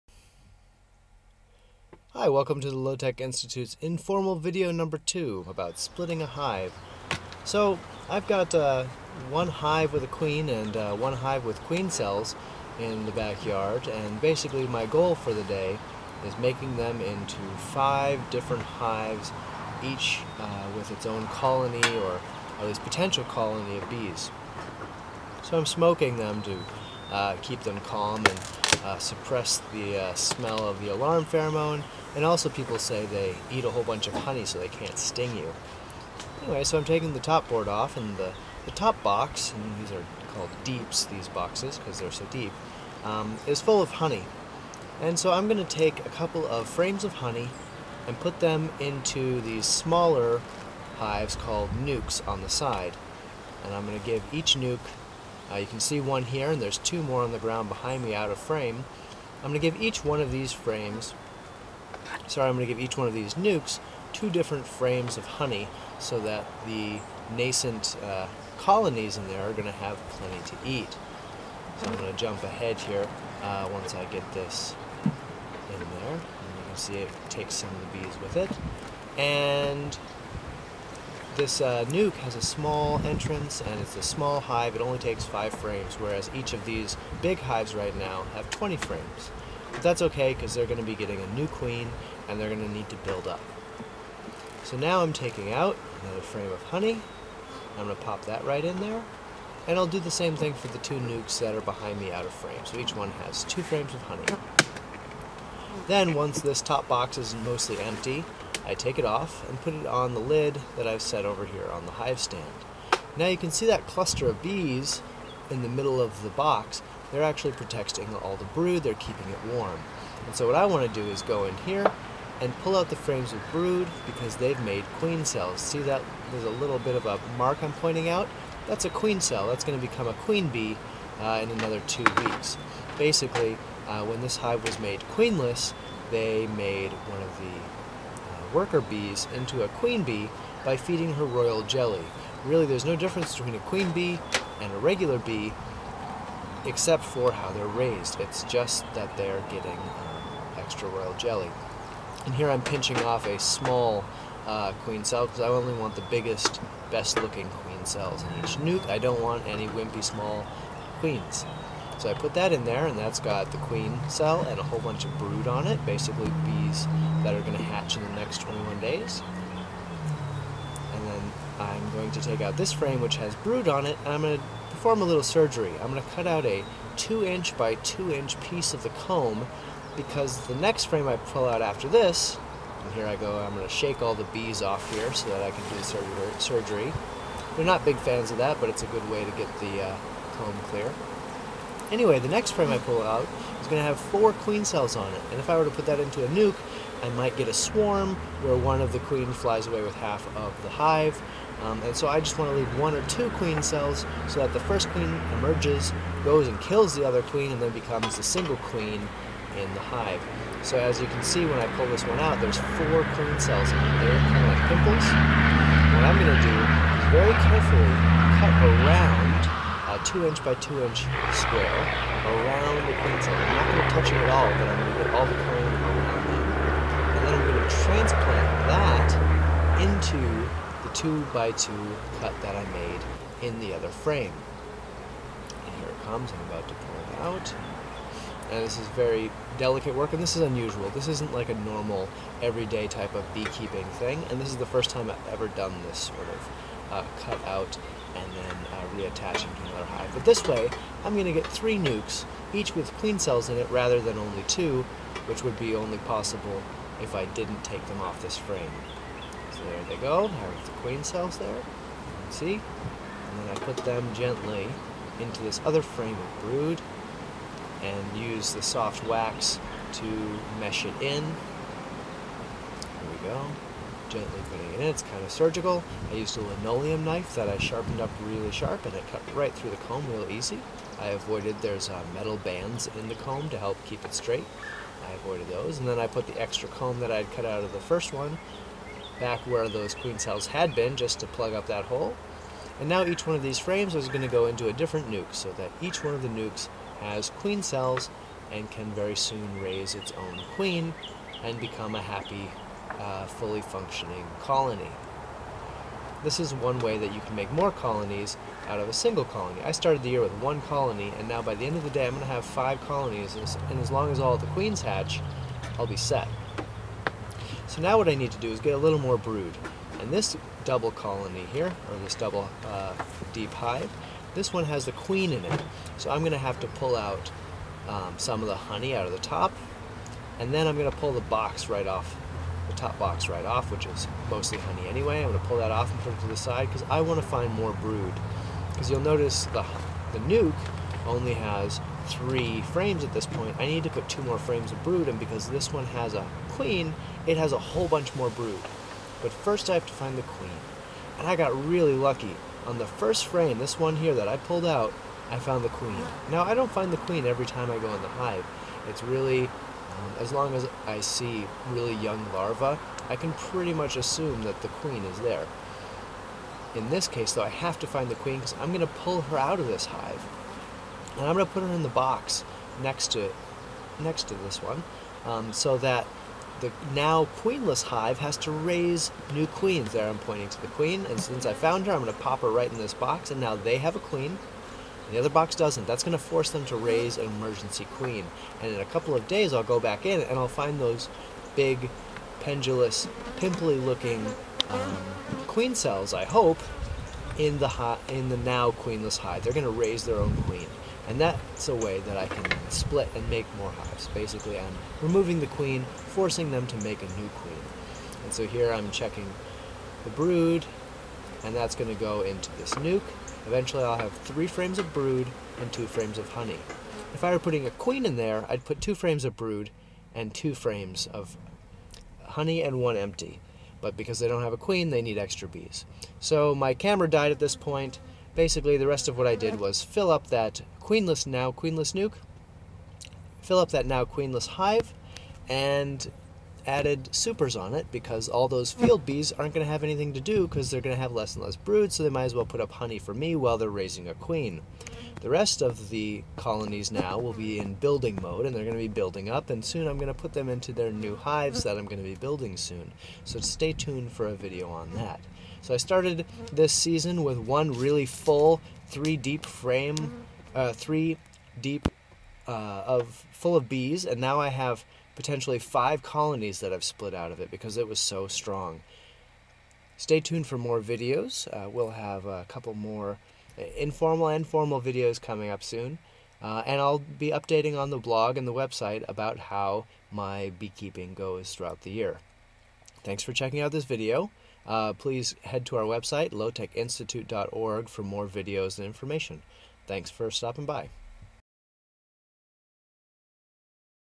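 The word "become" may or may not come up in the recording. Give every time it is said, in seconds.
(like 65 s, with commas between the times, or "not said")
129 s, 207 s, 301 s.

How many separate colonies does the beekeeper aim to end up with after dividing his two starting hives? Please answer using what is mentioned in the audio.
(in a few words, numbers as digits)
5.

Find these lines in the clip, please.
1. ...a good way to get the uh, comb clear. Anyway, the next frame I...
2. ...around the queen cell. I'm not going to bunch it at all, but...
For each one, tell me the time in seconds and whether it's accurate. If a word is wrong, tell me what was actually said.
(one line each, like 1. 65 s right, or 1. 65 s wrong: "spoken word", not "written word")
1. 188 s right
2. 222 s wrong: "touch", not "bunch".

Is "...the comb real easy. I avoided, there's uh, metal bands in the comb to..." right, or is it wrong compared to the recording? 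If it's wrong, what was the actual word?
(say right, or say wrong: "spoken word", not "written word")
right.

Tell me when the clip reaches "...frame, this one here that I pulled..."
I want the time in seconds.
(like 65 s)
353 s.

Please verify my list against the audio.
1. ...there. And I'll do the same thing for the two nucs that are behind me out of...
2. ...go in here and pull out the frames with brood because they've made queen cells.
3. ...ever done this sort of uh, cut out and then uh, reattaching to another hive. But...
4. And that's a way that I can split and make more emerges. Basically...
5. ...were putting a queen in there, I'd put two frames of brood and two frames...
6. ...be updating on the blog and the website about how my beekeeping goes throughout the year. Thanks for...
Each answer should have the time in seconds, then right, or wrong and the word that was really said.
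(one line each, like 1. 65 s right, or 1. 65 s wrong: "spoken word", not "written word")
1. 98 s right
2. 121 s right
3. 245 s right
4. 401 s wrong: "hives", not "emerges"
5. 417 s right
6. 476 s right.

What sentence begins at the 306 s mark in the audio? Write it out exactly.
This is one way that you can make more colonies out of a single colony.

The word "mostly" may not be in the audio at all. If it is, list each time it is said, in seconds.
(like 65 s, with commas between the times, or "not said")
107 s, 334 s.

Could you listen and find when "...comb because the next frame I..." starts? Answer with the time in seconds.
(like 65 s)
178 s.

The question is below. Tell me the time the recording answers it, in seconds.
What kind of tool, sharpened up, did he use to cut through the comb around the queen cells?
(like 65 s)
276 s.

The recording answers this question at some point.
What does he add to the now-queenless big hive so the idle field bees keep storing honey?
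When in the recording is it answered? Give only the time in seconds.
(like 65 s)
437 s.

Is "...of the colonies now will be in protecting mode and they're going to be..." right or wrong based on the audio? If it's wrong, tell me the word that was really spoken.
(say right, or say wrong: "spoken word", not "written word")
wrong: "building", not "protecting".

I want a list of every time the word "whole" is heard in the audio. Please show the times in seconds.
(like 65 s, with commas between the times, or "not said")
33 s, 164 s, 347 s.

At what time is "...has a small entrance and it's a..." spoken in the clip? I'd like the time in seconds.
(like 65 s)
82 s.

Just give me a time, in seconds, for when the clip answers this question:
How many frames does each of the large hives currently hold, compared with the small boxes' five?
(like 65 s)
88 s.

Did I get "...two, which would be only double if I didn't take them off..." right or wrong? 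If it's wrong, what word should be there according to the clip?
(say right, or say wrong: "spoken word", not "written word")
wrong: "possible", not "double".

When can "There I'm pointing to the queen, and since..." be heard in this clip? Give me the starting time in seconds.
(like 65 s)
379 s.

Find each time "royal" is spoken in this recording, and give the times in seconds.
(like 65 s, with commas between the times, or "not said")
141 s, 150 s.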